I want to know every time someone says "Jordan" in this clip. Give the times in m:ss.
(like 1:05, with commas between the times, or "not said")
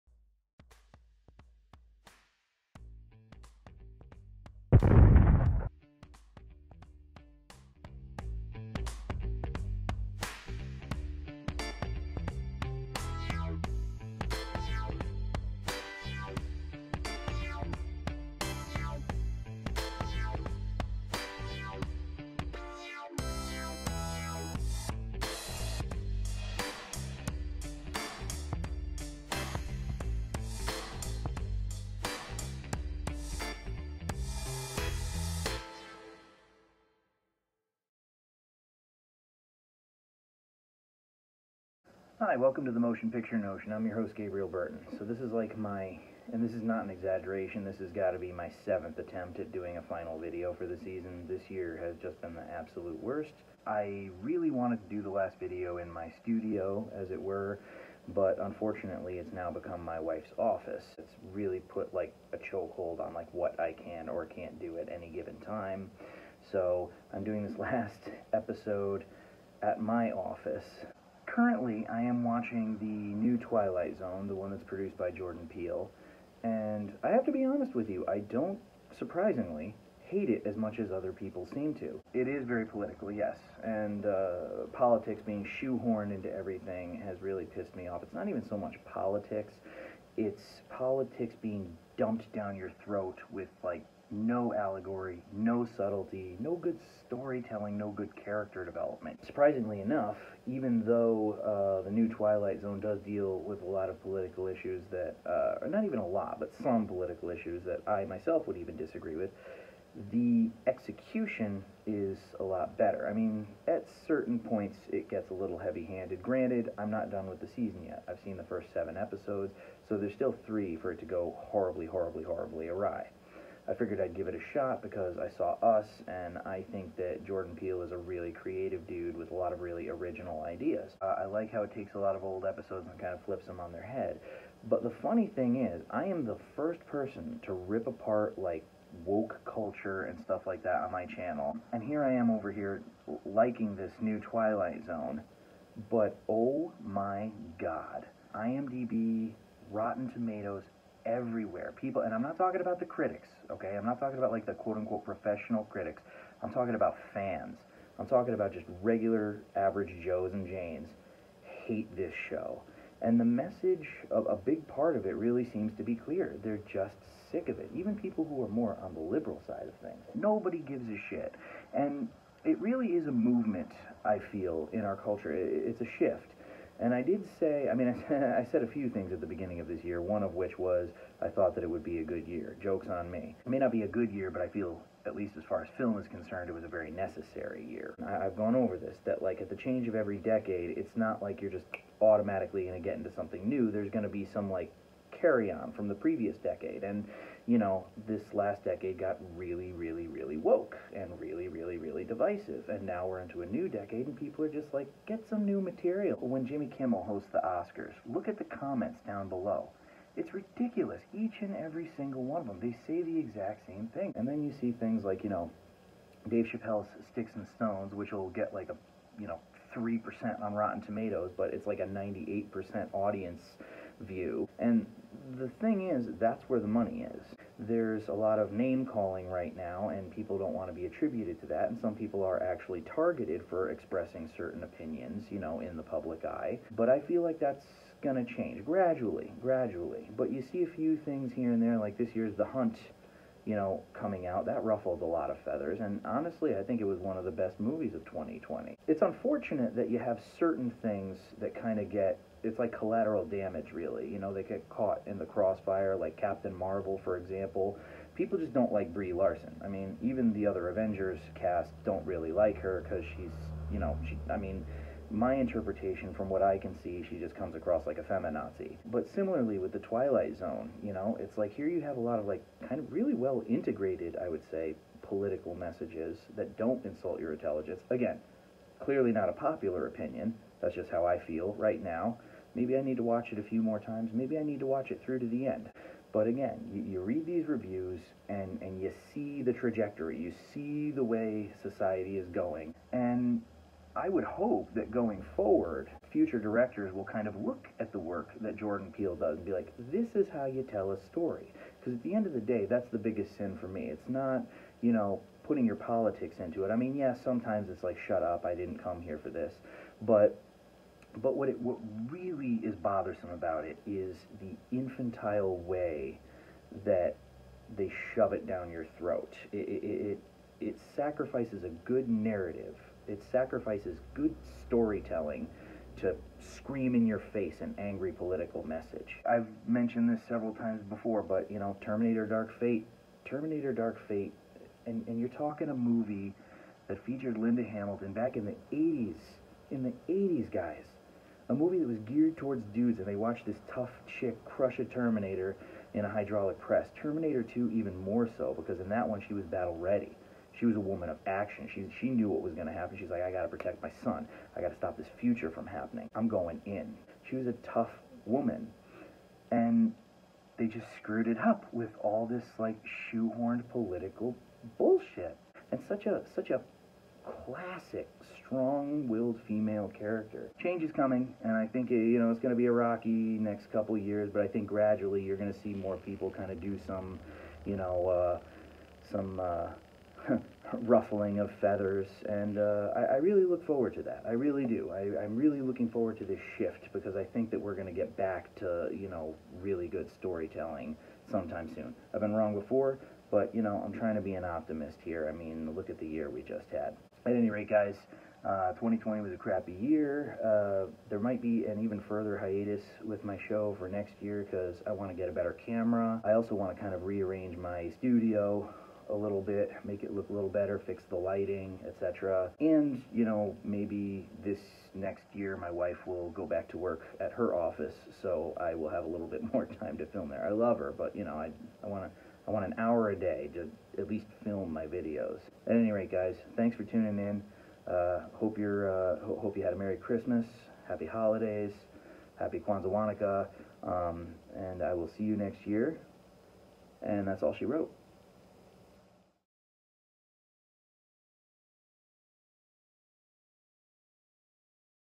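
1:15, 2:07, 4:58.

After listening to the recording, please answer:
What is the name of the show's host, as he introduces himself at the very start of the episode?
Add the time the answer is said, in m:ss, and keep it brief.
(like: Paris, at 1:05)
Gabriel Burton, at 0:44.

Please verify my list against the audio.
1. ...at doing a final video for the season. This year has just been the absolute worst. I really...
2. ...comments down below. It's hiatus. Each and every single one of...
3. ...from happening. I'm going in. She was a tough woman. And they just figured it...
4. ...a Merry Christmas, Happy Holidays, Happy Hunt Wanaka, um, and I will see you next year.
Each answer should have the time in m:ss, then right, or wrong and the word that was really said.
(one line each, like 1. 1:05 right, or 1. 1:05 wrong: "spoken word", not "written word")
1. 0:49 right
2. 3:28 wrong: "ridiculous", not "hiatus"
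3. 5:55 wrong: "screwed", not "figured"
4. 7:09 wrong: "Kwanzaa", not "Hunt".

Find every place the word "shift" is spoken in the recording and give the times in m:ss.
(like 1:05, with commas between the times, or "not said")
2:55, 6:26.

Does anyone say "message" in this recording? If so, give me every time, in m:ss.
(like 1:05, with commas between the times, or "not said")
2:43, 4:35, 5:28.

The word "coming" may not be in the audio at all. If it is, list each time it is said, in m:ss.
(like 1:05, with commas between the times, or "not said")
4:03, 6:10.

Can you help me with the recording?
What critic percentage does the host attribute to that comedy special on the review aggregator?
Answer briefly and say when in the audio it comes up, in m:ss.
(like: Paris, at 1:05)
3%, at 3:39.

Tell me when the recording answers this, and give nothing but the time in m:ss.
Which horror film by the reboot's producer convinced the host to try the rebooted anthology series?
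2:05.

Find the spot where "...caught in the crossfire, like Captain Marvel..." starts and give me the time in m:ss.
4:14.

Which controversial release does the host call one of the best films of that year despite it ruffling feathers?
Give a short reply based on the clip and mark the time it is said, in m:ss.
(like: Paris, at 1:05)
The Hunt, at 4:02.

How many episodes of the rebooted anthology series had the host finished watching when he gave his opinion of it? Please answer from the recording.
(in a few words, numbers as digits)
7.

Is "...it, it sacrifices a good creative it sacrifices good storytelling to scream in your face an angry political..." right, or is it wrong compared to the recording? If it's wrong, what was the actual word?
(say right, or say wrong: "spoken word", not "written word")
wrong: "narrative", not "creative".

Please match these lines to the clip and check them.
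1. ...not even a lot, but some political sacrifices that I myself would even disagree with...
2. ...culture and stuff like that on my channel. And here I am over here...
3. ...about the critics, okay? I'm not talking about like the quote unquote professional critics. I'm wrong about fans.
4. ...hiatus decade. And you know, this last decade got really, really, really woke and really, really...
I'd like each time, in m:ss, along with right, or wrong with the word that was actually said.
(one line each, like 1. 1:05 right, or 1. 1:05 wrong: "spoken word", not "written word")
1. 1:45 wrong: "issues", not "sacrifices"
2. 2:19 right
3. 2:32 wrong: "talking", not "wrong"
4. 3:15 wrong: "previous", not "hiatus".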